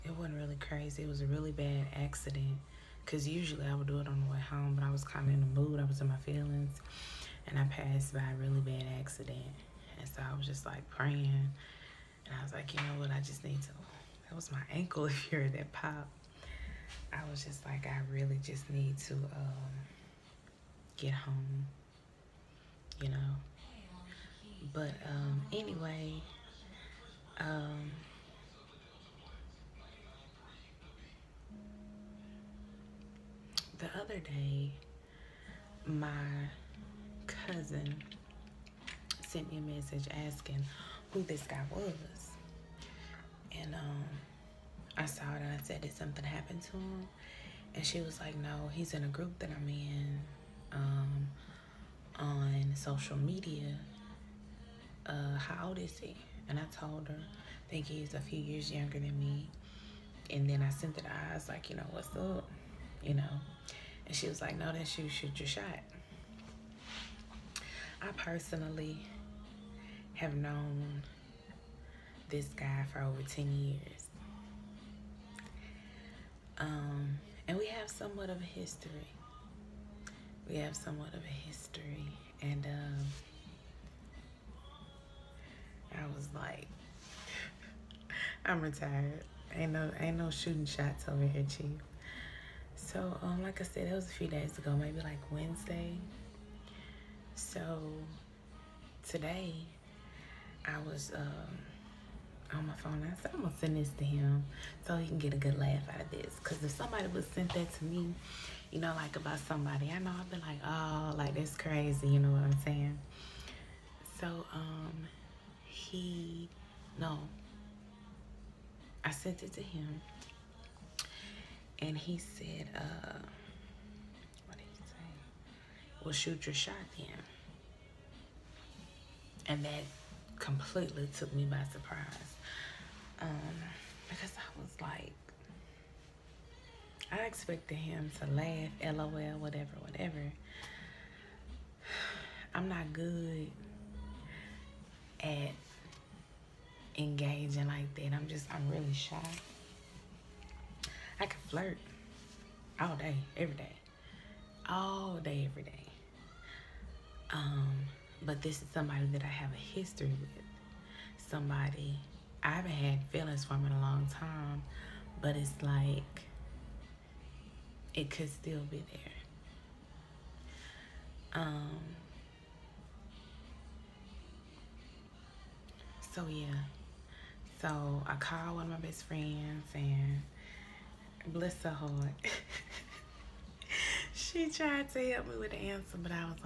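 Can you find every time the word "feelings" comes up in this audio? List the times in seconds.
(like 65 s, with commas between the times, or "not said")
6 s, 163 s.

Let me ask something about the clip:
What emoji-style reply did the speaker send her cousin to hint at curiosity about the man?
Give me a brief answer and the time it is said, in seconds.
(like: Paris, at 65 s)
the eyes, at 61 s.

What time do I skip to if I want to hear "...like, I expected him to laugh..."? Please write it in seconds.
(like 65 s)
134 s.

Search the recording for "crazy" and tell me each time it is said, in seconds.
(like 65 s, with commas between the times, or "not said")
0 s, 111 s.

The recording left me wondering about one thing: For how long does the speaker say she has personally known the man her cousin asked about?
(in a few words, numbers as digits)
over 10 years.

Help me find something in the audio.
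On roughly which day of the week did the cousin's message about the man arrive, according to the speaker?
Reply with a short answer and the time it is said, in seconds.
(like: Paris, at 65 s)
Wednesday, at 95 s.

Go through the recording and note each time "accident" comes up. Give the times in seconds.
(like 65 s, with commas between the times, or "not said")
1 s, 9 s.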